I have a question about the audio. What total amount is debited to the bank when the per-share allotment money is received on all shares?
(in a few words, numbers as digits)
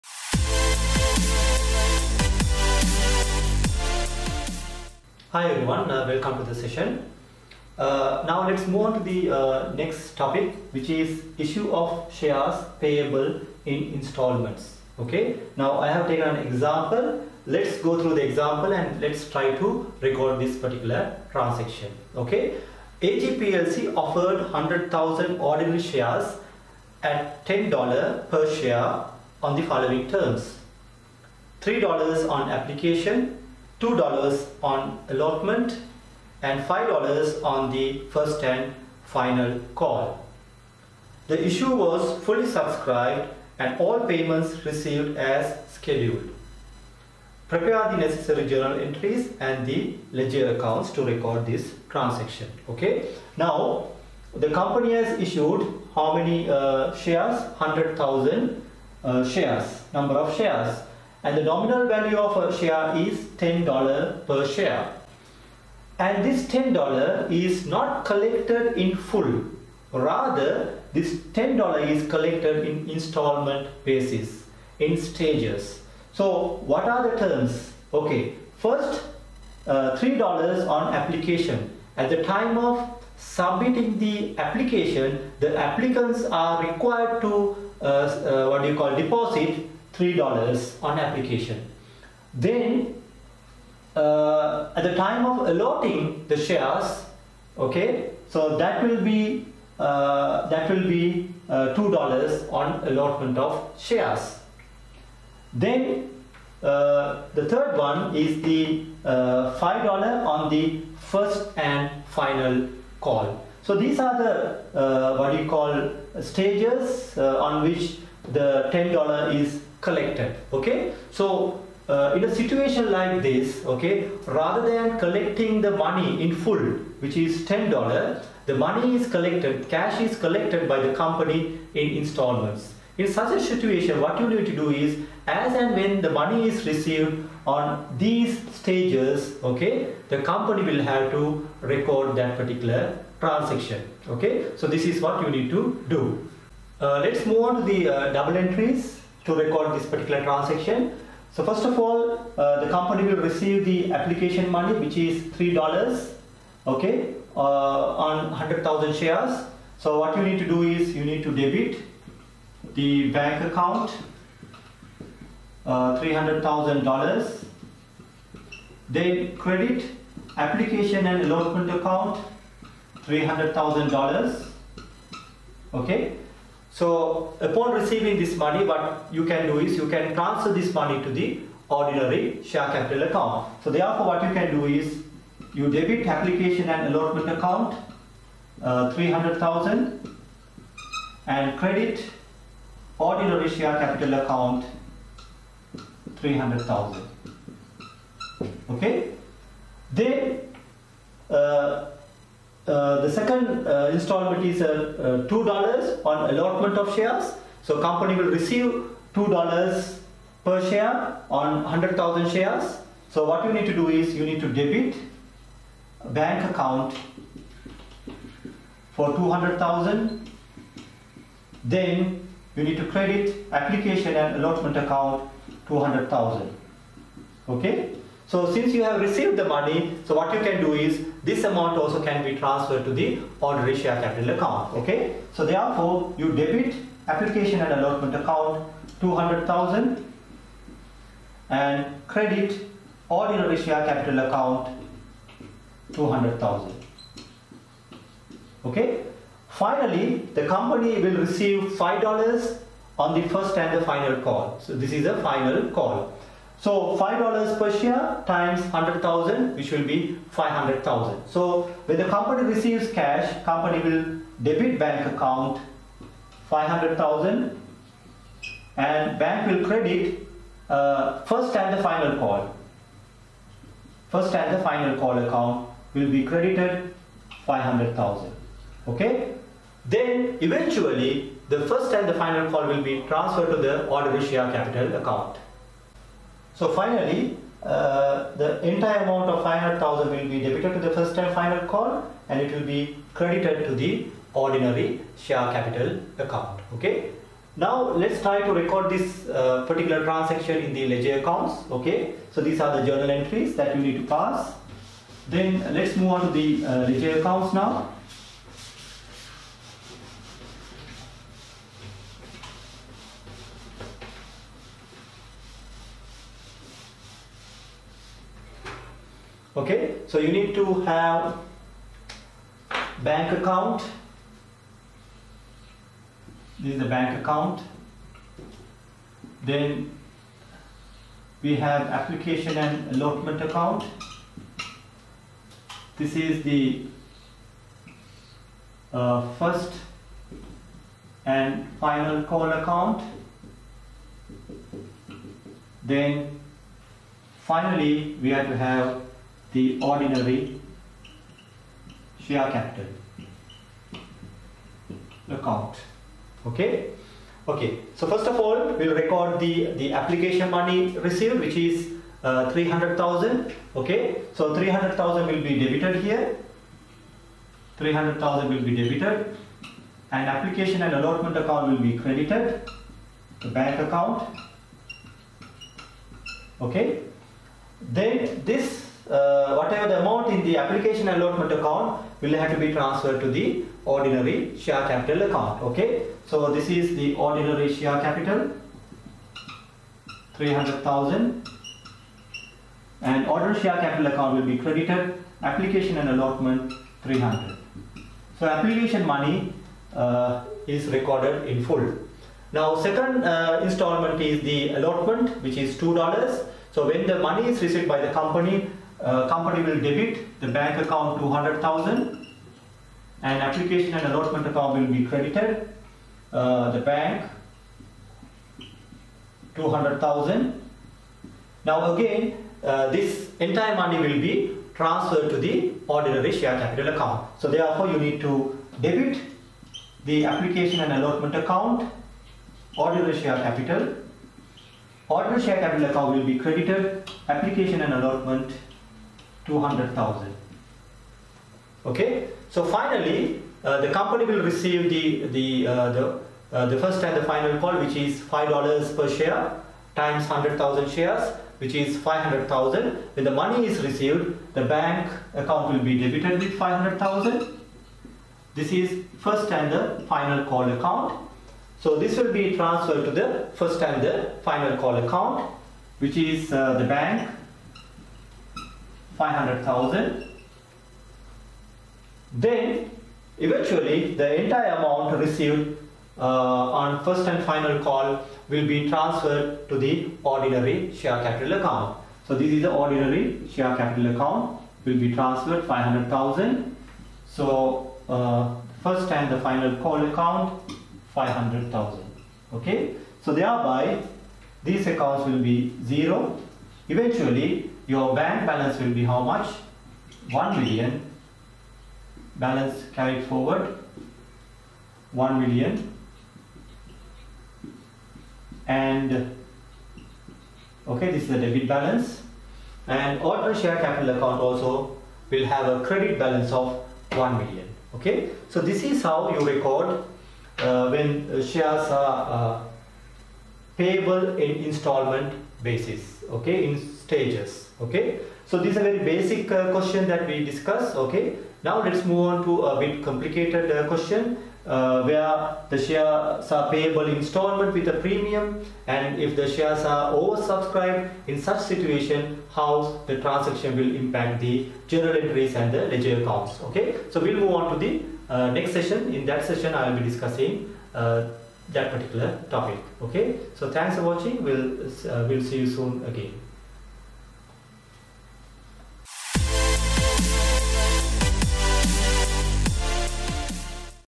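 200,000.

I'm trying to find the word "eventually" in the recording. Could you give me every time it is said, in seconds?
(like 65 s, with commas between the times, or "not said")
280 s, 473 s, 496 s.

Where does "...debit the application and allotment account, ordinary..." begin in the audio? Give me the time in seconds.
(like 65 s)
428 s.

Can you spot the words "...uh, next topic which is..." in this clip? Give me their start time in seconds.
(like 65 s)
9 s.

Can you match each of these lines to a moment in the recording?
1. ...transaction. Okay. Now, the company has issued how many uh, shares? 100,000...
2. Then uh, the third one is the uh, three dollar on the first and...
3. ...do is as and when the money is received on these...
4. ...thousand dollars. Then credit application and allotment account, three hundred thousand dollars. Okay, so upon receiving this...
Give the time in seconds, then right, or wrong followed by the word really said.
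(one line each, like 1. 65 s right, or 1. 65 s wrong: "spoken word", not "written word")
1. 51 s right
2. 105 s wrong: "five", not "three"
3. 134 s right
4. 166 s right.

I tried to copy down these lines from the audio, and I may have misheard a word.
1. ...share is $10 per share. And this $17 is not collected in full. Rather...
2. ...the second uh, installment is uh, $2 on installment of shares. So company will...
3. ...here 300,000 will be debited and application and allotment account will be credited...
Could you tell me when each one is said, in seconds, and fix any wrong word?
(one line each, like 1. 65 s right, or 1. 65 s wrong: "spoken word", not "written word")
1. 62 s wrong: "10", not "17"
2. 203 s wrong: "allotment", not "installment"
3. 366 s right.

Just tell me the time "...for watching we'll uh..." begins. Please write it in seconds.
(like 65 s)
553 s.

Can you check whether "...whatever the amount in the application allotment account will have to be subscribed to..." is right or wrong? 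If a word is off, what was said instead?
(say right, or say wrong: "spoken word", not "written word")
wrong: "transferred", not "subscribed".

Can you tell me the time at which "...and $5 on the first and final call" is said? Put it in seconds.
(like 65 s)
36 s.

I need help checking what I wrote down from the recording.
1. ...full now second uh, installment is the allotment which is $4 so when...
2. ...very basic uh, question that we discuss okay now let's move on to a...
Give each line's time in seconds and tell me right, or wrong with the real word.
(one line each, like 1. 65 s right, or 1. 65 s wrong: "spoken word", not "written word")
1. 401 s wrong: "2", not "4"
2. 528 s right.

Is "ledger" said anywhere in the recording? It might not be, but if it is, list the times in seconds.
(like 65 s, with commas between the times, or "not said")
50 s, 300 s, 306 s, 545 s.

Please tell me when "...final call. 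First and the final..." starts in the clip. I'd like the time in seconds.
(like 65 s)
271 s.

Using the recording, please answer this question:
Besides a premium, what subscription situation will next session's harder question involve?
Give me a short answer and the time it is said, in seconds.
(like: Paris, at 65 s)
Oversubscribed, at 540 s.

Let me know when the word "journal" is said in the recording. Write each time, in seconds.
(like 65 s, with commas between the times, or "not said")
48 s, 302 s, 544 s.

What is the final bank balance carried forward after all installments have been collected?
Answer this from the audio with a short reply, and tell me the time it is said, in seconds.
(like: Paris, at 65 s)
1 million, at 502 s.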